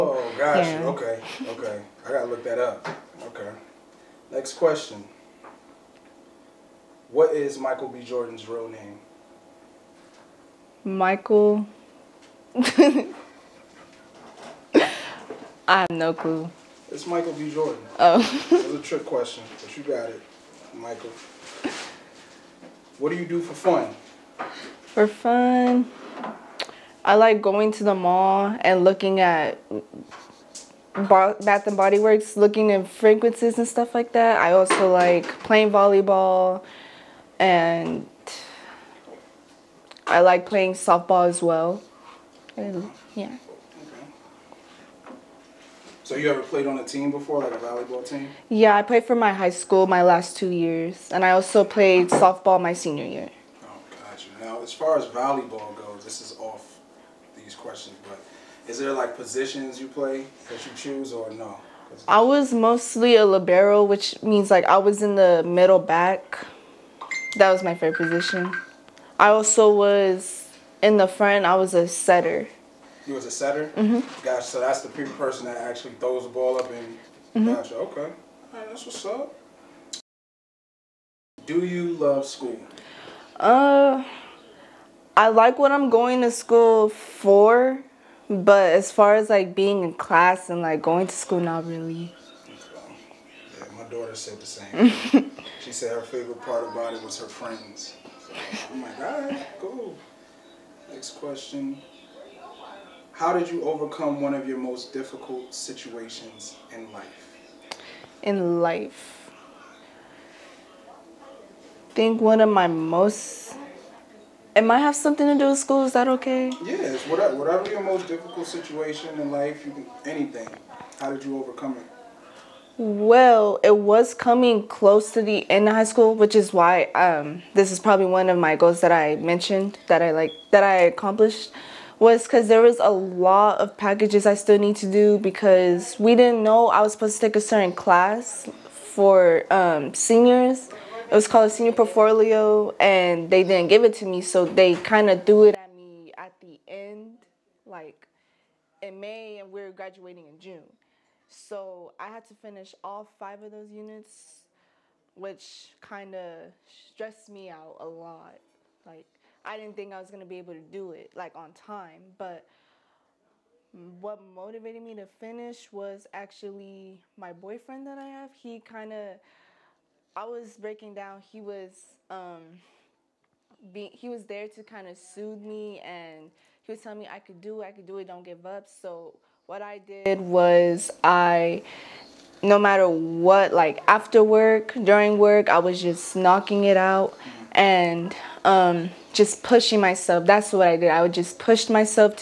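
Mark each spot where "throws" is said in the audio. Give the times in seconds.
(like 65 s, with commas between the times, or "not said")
75 s.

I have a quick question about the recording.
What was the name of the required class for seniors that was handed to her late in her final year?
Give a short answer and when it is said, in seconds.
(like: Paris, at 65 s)
Senior portfolio, at 141 s.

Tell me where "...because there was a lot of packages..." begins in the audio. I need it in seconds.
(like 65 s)
132 s.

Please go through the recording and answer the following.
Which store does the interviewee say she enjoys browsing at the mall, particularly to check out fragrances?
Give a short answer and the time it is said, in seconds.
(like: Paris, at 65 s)
Bath and Body Works, at 30 s.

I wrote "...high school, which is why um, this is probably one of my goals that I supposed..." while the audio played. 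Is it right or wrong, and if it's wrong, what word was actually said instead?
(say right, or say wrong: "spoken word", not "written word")
wrong: "mentioned", not "supposed".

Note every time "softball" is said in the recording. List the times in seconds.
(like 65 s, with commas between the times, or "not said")
40 s, 52 s.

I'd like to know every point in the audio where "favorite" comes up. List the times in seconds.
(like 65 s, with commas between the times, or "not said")
67 s, 96 s.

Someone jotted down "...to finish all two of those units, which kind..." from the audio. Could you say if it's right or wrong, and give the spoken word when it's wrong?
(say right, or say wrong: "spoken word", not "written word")
wrong: "five", not "two".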